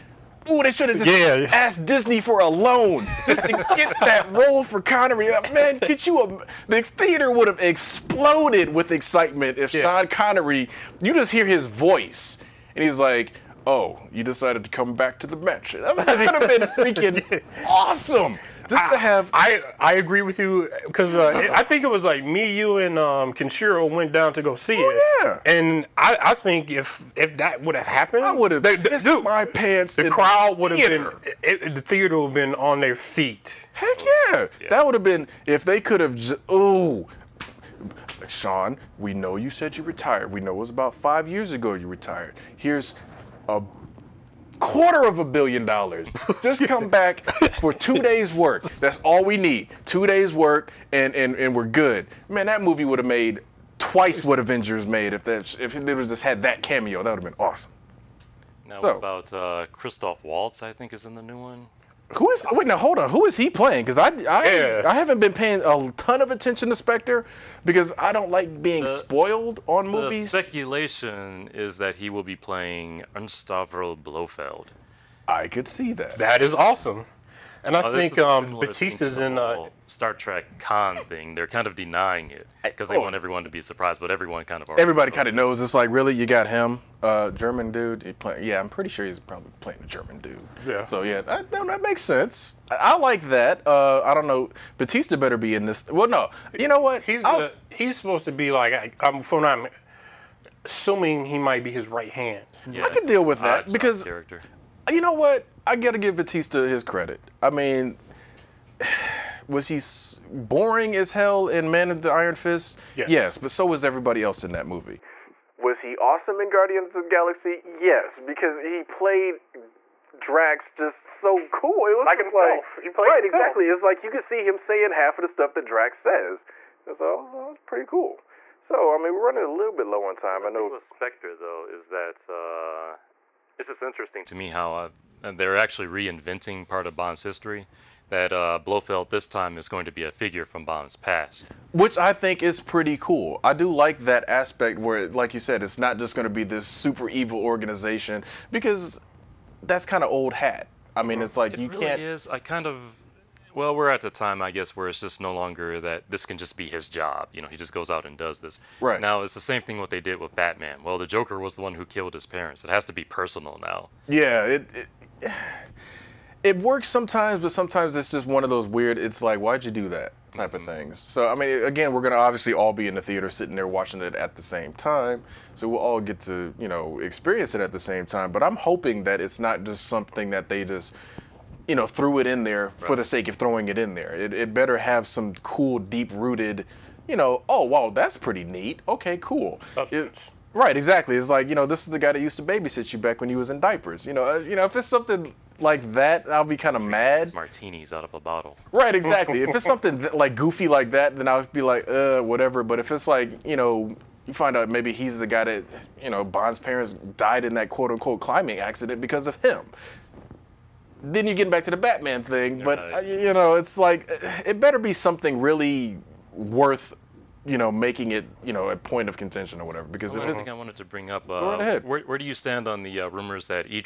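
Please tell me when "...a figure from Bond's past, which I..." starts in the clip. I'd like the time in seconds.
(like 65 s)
140 s.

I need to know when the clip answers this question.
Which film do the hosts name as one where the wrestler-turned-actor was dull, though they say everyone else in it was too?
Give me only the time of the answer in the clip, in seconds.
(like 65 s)
111 s.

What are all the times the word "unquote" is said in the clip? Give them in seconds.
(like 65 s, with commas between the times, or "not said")
207 s.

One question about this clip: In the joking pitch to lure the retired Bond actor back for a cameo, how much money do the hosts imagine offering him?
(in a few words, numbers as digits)
a quarter of a billion dollars.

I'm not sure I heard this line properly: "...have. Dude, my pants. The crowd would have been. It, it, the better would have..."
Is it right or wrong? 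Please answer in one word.
wrong.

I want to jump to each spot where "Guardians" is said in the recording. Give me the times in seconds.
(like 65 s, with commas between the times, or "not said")
116 s.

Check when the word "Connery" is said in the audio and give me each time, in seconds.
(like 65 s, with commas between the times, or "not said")
4 s, 10 s.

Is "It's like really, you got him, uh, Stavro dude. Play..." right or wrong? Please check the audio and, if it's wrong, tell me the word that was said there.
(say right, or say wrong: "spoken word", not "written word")
wrong: "German", not "Stavro".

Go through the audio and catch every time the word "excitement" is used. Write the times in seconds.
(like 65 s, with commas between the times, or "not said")
8 s.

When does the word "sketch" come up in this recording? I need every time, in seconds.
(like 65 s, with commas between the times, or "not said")
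not said.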